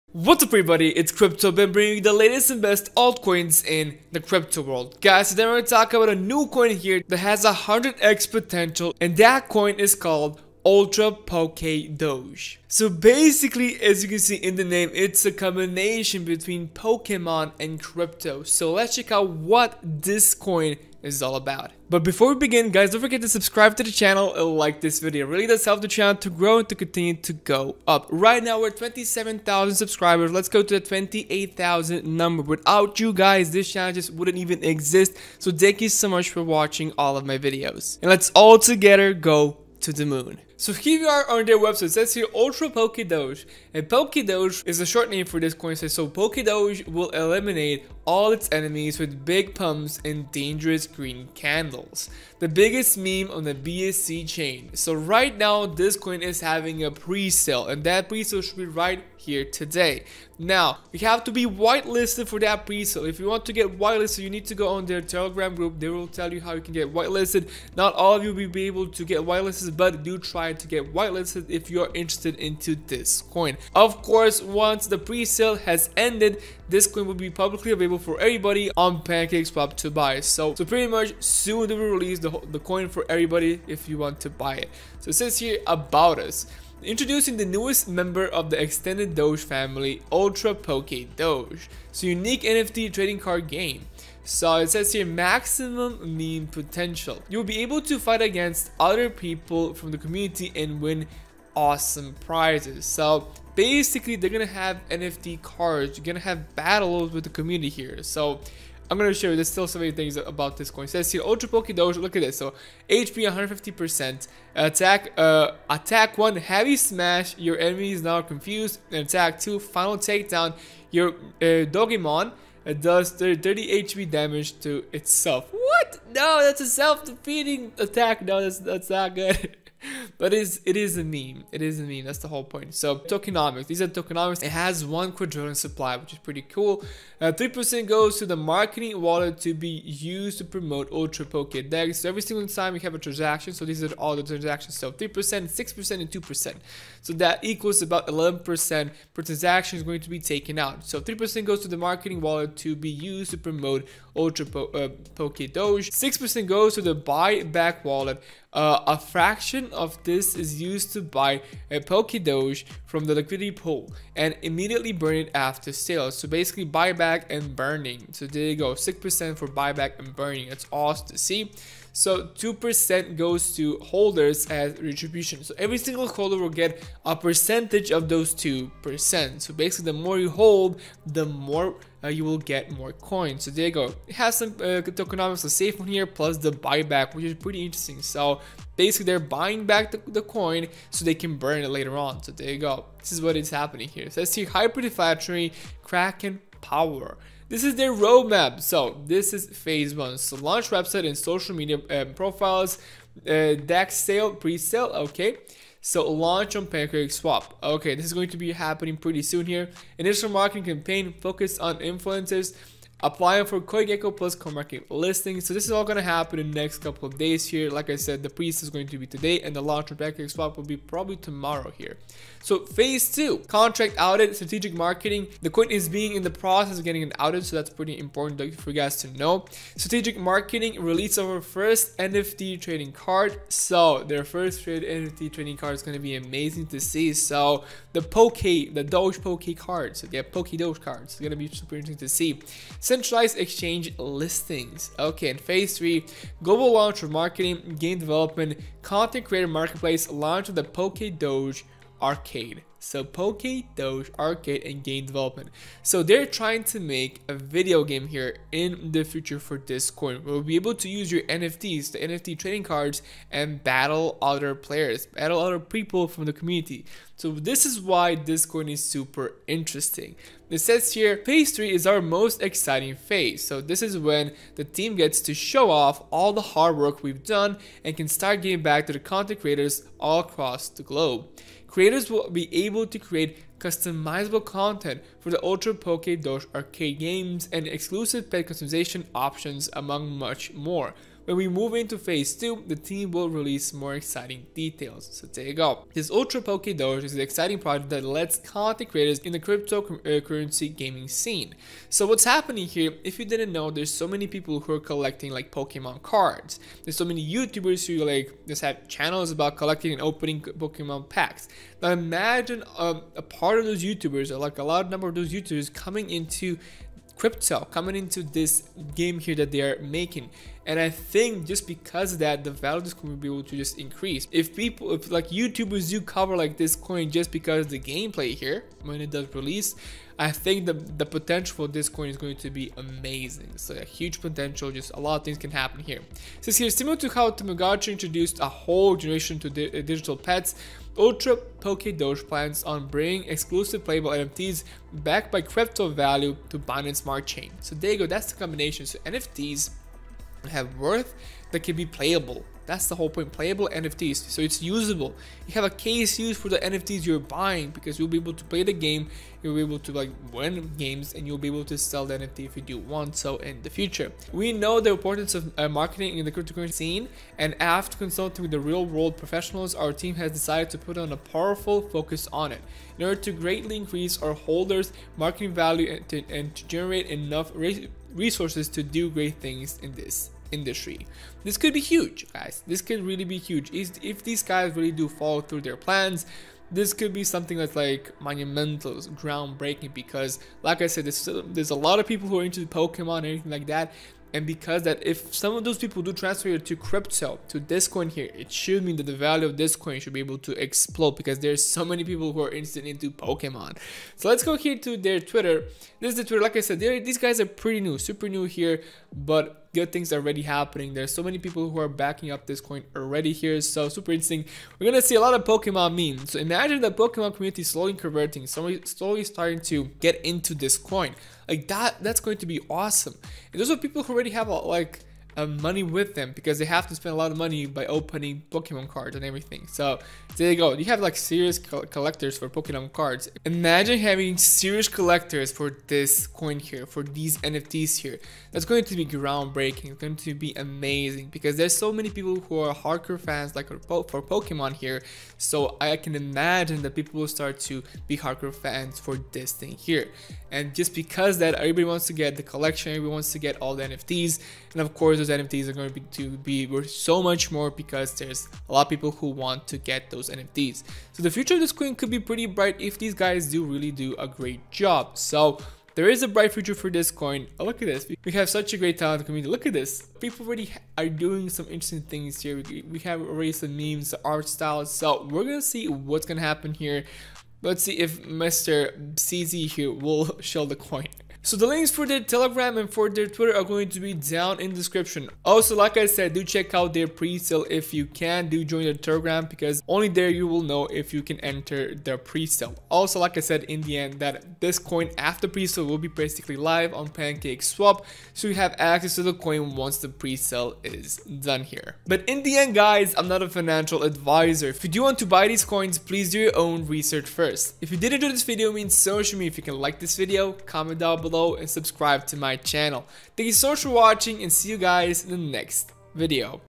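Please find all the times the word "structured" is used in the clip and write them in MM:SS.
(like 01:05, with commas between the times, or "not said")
not said.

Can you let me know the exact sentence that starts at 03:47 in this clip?
So that's pretty important for you guys to know.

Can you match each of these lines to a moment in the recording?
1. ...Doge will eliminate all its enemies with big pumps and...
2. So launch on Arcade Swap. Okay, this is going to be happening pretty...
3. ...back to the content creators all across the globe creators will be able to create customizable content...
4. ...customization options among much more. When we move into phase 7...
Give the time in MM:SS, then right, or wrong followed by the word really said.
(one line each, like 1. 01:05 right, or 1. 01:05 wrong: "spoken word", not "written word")
1. 00:46 right
2. 03:25 wrong: "Pancake", not "Arcade"
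3. 04:38 right
4. 04:48 wrong: "2", not "7".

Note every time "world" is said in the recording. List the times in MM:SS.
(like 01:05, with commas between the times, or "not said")
00:04, 06:08.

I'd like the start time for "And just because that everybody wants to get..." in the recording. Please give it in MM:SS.
07:30.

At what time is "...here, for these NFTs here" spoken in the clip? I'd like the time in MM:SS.
07:16.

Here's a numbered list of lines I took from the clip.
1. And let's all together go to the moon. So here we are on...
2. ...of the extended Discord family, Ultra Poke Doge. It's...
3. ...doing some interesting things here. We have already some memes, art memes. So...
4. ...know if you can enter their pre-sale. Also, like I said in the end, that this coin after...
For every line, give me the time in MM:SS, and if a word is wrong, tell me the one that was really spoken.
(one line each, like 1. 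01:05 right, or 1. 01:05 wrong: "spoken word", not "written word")
1. 00:38 right
2. 01:28 wrong: "Doge", not "Discord"
3. 07:51 wrong: "styles", not "memes"
4. 08:10 right.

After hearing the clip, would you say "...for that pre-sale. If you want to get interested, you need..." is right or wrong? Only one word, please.
wrong.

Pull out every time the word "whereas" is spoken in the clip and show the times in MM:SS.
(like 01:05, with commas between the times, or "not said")
not said.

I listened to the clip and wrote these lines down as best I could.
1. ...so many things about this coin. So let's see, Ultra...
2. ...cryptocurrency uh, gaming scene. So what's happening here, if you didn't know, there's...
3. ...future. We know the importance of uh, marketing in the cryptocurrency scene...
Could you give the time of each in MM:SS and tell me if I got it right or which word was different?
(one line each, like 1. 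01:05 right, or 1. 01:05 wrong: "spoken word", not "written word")
1. 01:49 right
2. 04:59 right
3. 06:03 right.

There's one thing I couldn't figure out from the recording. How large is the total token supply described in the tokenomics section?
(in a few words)
One quadrillion.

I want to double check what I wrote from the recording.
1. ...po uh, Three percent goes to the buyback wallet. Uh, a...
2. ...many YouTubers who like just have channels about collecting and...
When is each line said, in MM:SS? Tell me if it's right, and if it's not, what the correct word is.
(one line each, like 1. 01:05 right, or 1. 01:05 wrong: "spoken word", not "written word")
1. 02:34 wrong: "Six", not "Three"
2. 05:07 right.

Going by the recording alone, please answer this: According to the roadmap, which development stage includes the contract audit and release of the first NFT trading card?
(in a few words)
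Phase two.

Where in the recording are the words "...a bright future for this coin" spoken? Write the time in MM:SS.
07:46.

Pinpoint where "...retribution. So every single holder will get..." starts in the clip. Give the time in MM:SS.
02:54.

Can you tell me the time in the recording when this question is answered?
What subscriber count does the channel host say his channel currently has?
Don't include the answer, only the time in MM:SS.
00:28.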